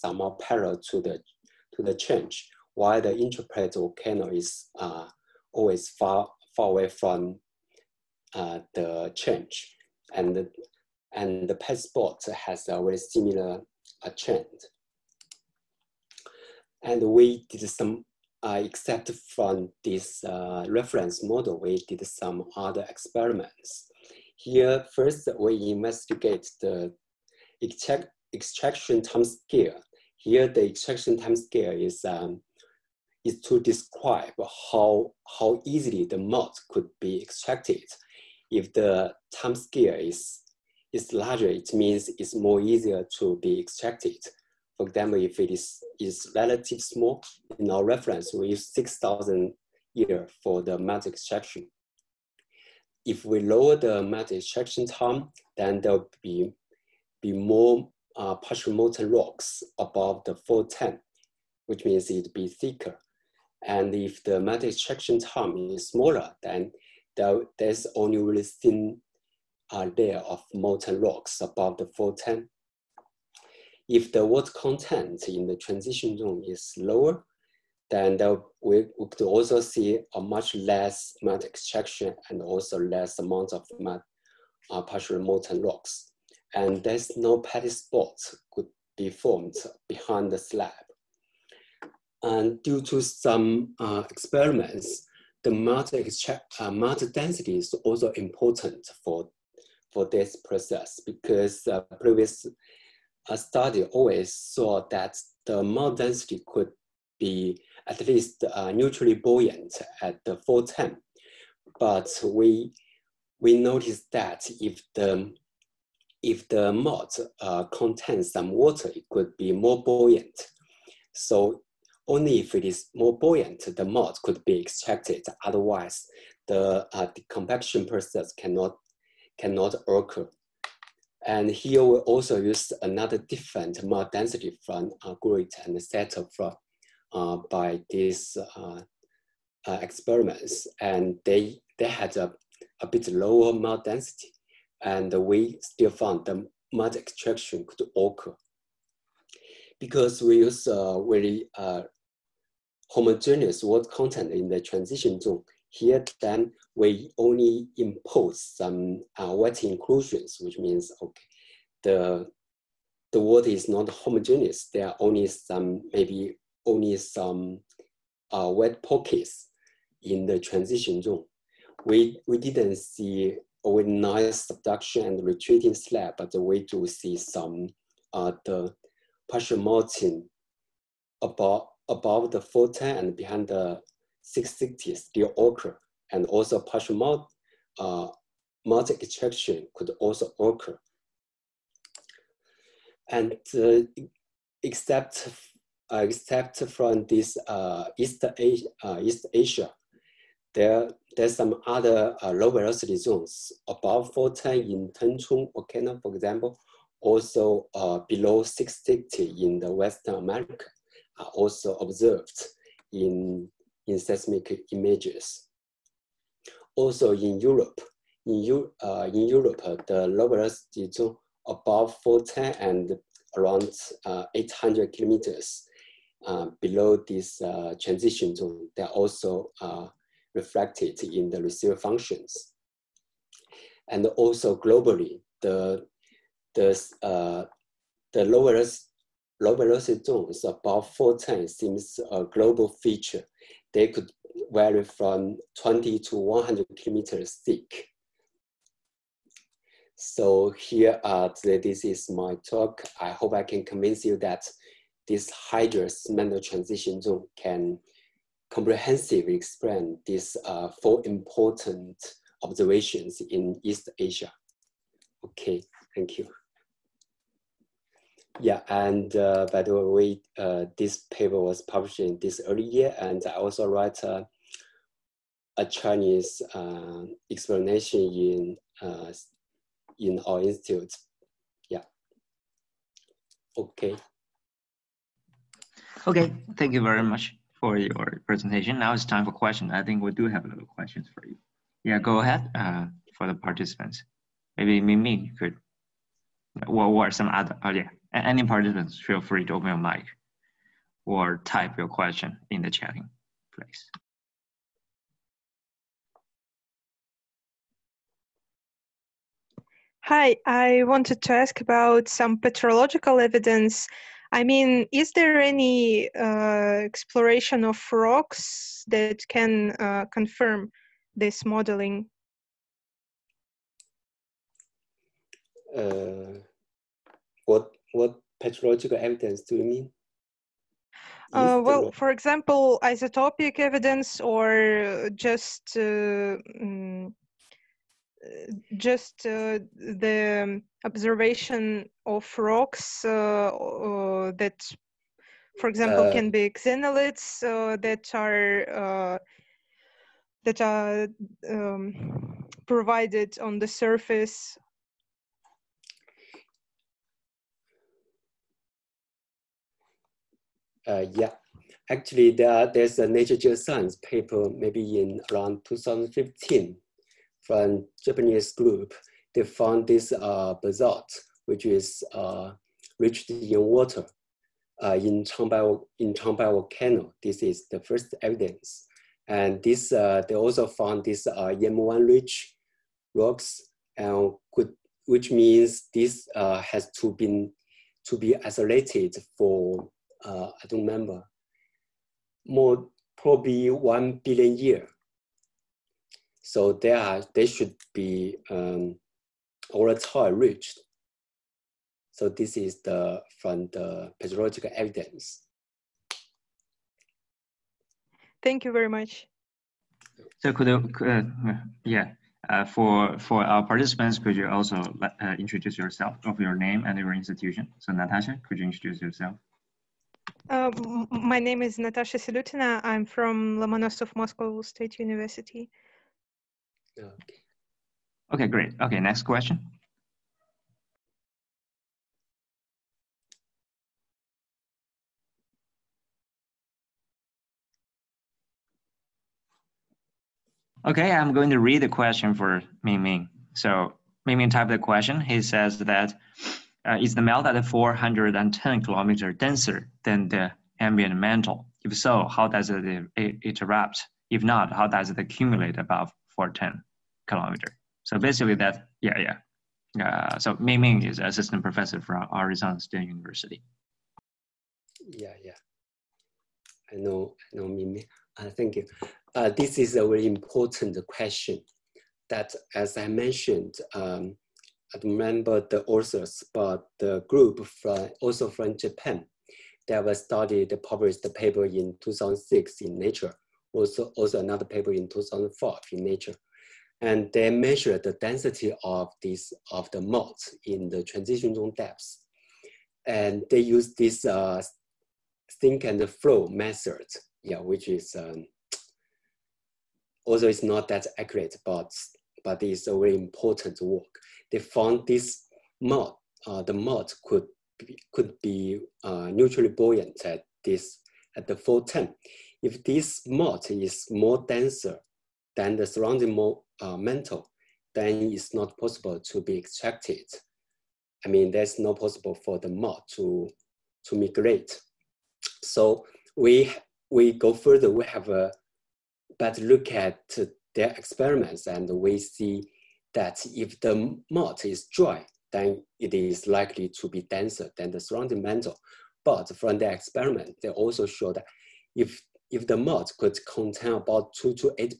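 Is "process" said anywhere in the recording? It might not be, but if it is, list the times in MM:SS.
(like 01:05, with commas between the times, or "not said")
01:40, 02:07.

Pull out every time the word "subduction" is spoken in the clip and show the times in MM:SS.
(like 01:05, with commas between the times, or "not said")
02:54.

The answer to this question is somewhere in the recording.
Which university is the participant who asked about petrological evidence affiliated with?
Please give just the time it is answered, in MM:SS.
07:03.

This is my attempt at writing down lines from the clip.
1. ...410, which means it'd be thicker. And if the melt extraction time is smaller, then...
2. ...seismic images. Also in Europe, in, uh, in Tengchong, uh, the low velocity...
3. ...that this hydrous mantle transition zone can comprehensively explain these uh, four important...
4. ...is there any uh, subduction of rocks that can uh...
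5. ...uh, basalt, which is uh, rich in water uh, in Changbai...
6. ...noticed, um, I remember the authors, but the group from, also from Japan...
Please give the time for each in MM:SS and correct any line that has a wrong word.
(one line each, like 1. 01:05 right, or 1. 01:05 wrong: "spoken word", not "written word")
1. 01:00 right
2. 03:33 wrong: "Europe", not "Tengchong"
3. 04:14 right
4. 05:14 wrong: "exploration", not "subduction"
5. 06:10 right
6. 07:53 wrong: "mentioned", not "noticed".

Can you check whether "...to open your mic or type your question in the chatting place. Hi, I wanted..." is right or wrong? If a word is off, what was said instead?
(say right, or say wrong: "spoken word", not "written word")
right.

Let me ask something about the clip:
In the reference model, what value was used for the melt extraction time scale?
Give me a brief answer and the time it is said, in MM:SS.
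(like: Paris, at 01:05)
6,000 years, at 00:48.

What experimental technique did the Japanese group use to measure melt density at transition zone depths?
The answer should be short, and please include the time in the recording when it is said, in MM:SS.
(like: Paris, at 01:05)
sink and flow method, at 08:15.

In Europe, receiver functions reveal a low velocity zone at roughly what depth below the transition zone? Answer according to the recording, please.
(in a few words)
800 kilometers.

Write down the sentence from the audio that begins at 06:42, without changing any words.
So this is the from the petrological evidence.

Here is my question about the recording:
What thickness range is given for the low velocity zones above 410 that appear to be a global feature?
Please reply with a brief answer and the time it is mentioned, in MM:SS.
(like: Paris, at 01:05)
20 to 100 kilometers, at 04:05.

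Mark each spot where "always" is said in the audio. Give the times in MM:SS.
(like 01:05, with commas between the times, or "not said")
00:05, 01:43.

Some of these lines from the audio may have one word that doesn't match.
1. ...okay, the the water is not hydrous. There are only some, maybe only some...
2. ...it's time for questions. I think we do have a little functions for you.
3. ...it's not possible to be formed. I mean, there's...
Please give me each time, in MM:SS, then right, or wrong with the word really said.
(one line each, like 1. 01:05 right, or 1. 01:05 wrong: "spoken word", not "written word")
1. 02:41 wrong: "homogeneous", not "hydrous"
2. 04:48 wrong: "questions", not "functions"
3. 08:38 wrong: "extracted", not "formed".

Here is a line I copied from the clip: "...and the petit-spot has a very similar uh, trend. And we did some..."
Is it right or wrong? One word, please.
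right.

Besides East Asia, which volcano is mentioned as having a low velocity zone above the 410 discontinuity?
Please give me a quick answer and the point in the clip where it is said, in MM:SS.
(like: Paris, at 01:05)
Tengchong, at 03:24.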